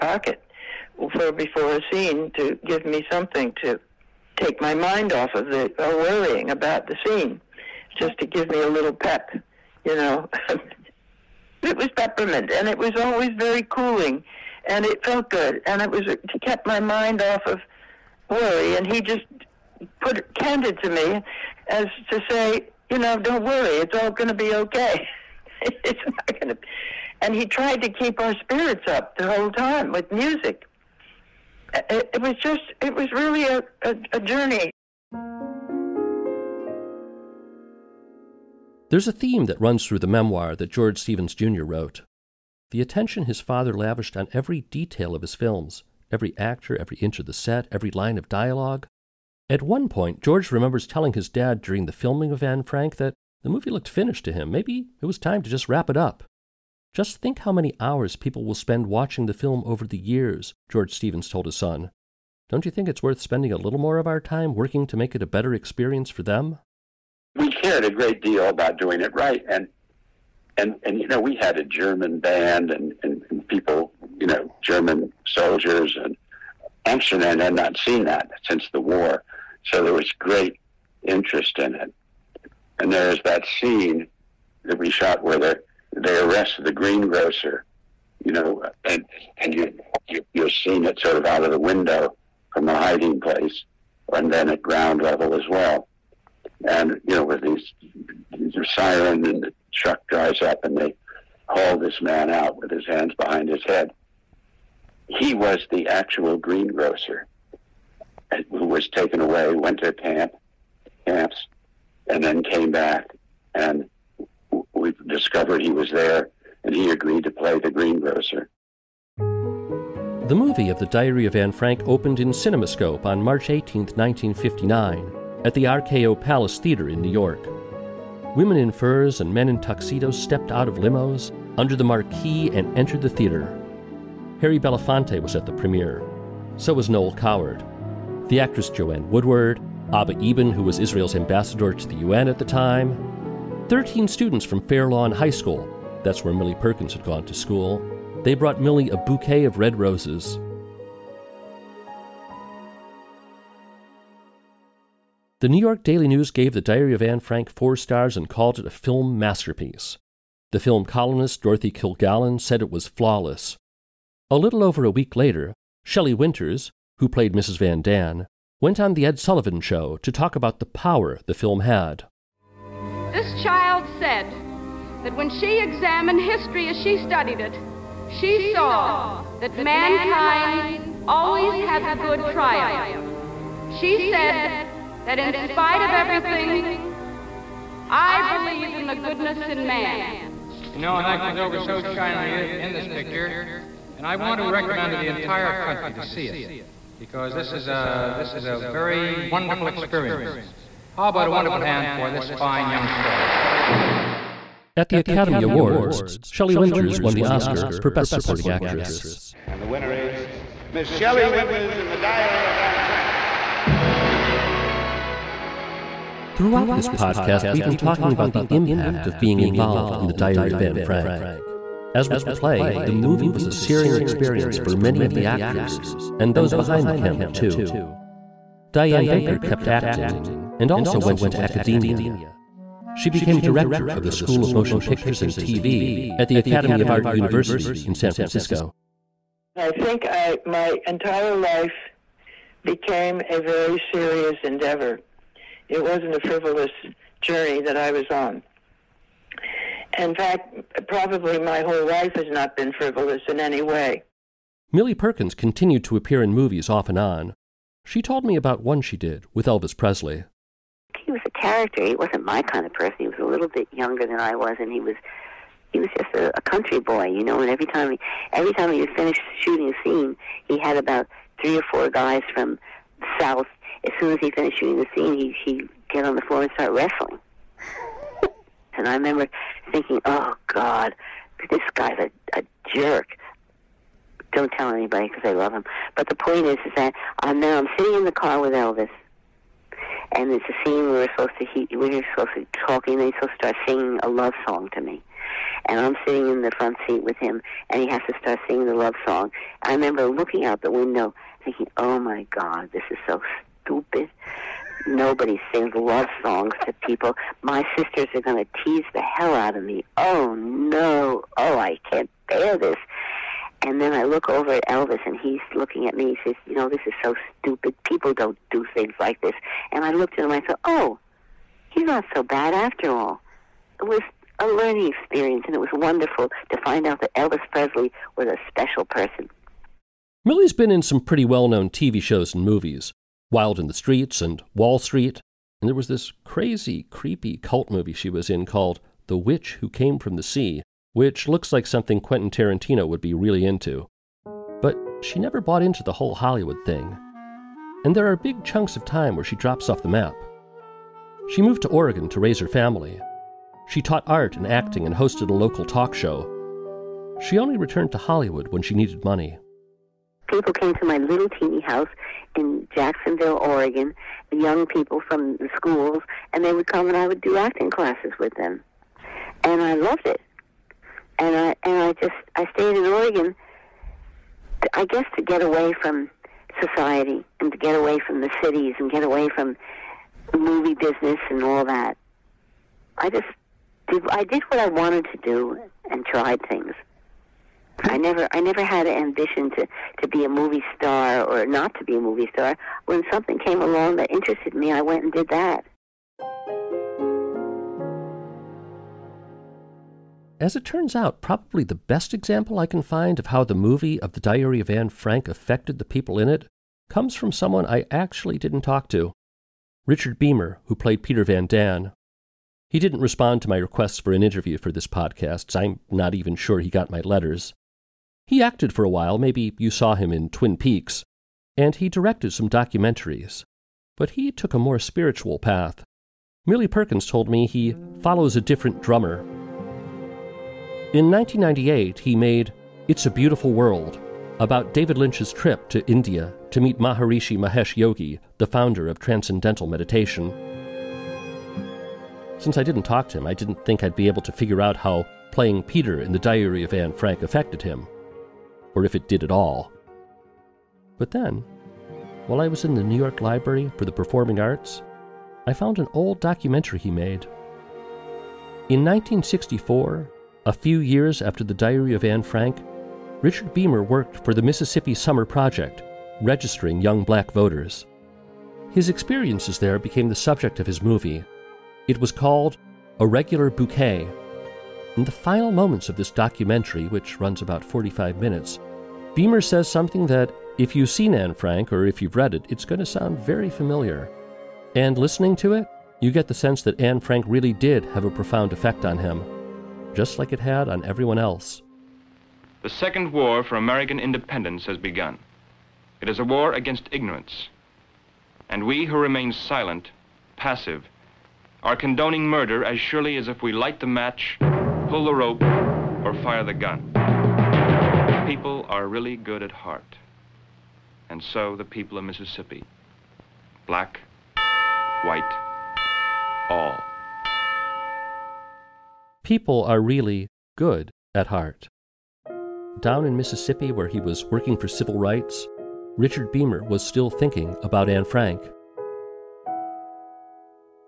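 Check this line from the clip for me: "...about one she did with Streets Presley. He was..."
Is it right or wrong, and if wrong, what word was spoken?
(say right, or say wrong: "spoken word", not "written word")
wrong: "Elvis", not "Streets".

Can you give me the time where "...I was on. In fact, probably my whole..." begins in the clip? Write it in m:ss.
4:07.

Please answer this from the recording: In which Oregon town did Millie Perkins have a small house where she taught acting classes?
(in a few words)
Jacksonville.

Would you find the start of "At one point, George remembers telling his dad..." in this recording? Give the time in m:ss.
0:49.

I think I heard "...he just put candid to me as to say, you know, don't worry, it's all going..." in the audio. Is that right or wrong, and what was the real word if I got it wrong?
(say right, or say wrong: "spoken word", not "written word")
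right.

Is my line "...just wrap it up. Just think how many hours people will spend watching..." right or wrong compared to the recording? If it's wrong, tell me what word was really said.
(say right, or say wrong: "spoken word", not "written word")
right.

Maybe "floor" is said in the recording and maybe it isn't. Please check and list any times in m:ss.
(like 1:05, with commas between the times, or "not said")
4:36.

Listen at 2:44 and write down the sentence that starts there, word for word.
A little over a week later, Shelley Winters, who played Mrs.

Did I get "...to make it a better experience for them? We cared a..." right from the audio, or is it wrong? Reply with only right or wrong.
right.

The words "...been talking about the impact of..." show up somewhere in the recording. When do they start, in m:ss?
3:37.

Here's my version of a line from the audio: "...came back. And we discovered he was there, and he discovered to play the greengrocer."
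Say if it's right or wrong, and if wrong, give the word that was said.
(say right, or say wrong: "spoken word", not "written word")
wrong: "agreed", not "discovered".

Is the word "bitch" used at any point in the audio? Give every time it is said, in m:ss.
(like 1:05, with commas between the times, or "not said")
not said.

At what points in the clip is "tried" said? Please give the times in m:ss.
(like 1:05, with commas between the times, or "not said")
0:27, 6:26.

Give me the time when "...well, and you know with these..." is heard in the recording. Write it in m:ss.
1:35.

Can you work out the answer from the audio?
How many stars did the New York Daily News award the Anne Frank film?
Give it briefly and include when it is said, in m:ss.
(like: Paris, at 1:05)
4, at 2:37.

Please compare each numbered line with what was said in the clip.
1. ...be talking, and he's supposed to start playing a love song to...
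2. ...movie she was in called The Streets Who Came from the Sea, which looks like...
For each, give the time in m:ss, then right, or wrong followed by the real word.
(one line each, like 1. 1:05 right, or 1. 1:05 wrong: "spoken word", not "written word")
1. 4:52 wrong: "singing", not "playing"
2. 5:37 wrong: "Witch", not "Streets".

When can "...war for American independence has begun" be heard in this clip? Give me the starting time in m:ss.
8:13.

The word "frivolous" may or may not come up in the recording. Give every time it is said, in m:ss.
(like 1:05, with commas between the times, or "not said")
4:06, 4:12.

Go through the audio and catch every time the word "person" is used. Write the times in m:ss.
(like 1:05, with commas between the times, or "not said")
4:22, 5:28.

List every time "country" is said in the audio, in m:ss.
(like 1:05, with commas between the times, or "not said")
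3:15, 4:26.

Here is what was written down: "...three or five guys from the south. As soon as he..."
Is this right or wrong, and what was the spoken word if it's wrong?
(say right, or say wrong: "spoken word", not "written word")
wrong: "four", not "five".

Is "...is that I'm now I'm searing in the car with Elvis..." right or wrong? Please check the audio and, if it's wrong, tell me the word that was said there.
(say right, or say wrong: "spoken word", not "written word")
wrong: "sitting", not "searing".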